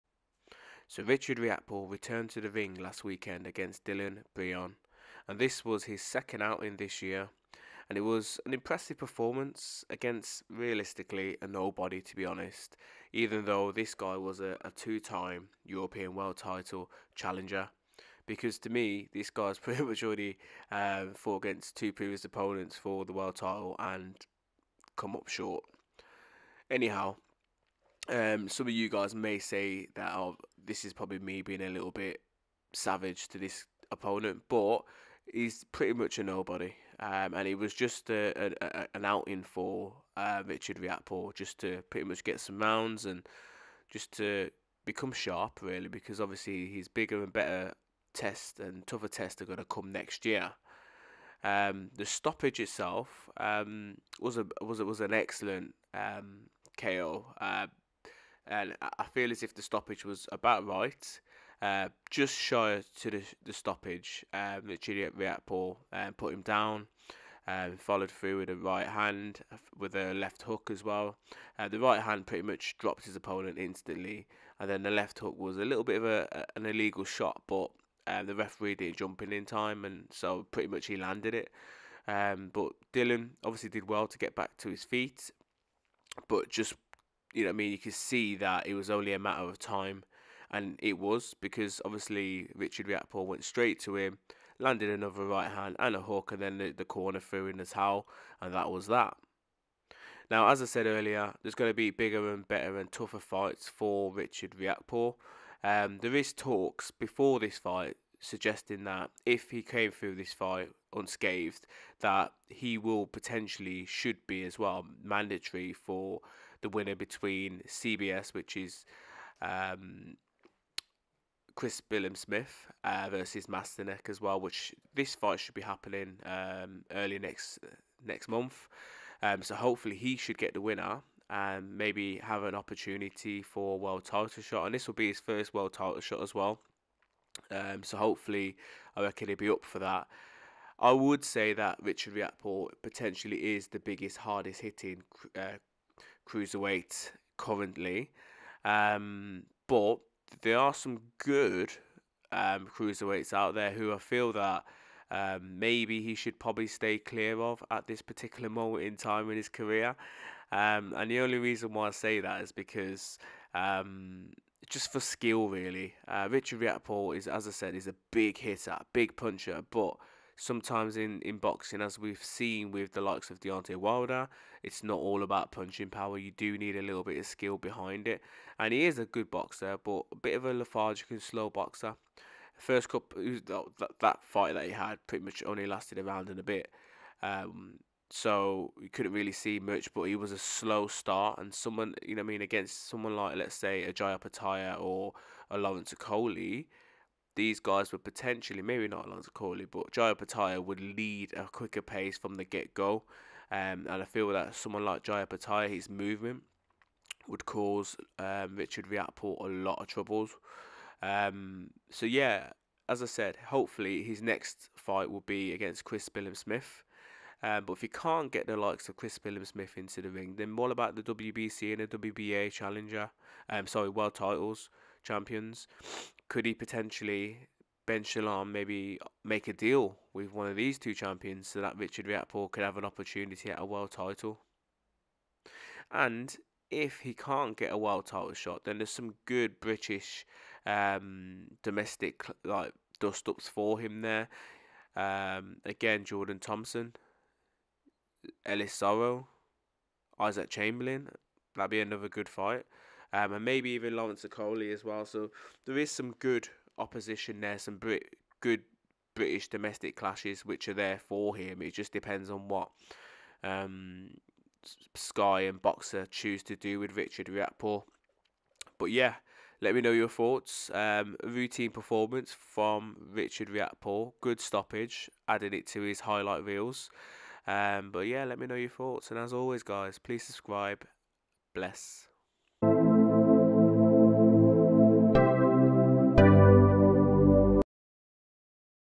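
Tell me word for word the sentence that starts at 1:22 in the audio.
Um, but Dylan obviously did well to get back to his feet, but just you know I mean?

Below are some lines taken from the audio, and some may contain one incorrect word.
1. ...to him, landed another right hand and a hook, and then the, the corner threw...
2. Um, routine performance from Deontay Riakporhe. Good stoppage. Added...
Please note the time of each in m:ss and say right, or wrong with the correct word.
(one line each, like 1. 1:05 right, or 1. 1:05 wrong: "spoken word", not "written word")
1. 1:33 right
2. 4:30 wrong: "Richard", not "Deontay".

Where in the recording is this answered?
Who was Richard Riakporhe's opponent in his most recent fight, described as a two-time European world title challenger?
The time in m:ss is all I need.
0:03.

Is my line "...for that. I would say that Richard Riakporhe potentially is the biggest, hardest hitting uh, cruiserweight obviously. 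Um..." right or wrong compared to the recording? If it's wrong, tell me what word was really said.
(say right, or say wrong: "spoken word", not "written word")
wrong: "currently", not "obviously".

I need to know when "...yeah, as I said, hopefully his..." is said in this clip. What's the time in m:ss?
3:32.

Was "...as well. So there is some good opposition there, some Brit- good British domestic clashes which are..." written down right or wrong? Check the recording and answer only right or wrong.
right.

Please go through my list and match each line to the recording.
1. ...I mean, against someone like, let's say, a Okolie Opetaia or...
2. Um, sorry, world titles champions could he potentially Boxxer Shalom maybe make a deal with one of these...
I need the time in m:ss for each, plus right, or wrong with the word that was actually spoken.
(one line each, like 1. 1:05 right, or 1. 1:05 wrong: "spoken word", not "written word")
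1. 3:12 wrong: "Jai", not "Okolie"
2. 3:43 wrong: "Ben", not "Boxxer".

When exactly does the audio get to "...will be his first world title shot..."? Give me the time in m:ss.
2:14.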